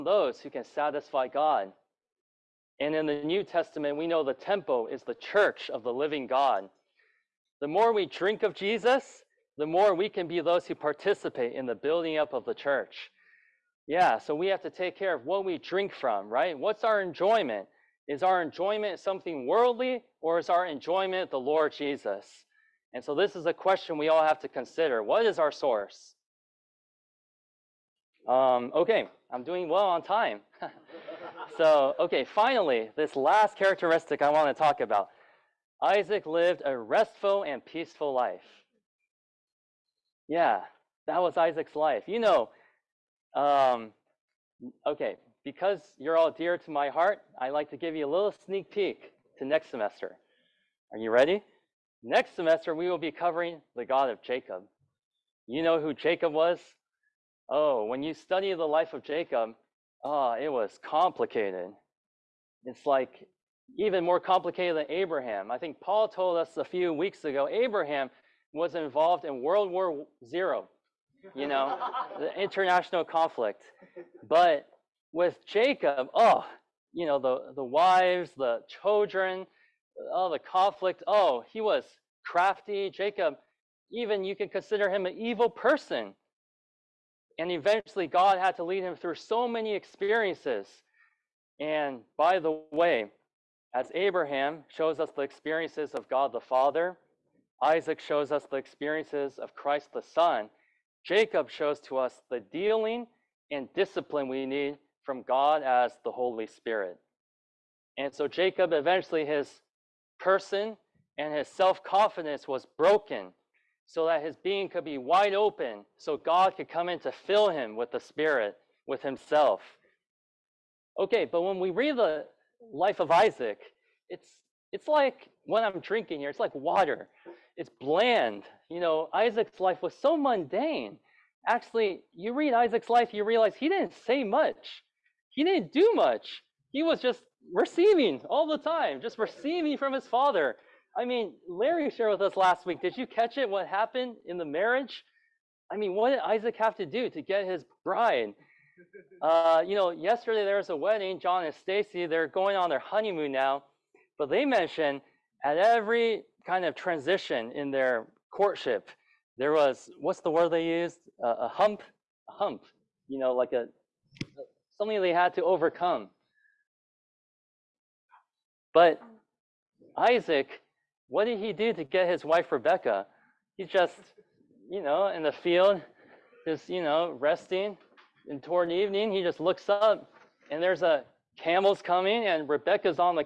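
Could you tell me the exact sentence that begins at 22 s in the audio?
And so this is a question we all have to consider.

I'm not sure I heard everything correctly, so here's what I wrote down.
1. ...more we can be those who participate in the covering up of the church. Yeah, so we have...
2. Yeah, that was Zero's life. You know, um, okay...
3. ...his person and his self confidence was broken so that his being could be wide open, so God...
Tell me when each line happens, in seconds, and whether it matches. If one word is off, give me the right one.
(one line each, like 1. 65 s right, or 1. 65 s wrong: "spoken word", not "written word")
1. 9 s wrong: "building", not "covering"
2. 40 s wrong: "Isaac", not "Zero"
3. 109 s right.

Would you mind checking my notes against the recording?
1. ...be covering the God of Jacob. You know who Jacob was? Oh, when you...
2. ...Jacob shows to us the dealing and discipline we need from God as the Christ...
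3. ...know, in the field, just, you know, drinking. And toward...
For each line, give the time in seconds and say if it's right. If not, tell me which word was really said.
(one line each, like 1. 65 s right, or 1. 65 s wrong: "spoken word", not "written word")
1. 52 s right
2. 101 s wrong: "Holy", not "Christ"
3. 174 s wrong: "resting", not "drinking".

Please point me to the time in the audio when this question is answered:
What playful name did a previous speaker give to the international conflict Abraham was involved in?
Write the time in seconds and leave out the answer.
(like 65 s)
69 s.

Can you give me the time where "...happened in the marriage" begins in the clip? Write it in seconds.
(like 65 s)
143 s.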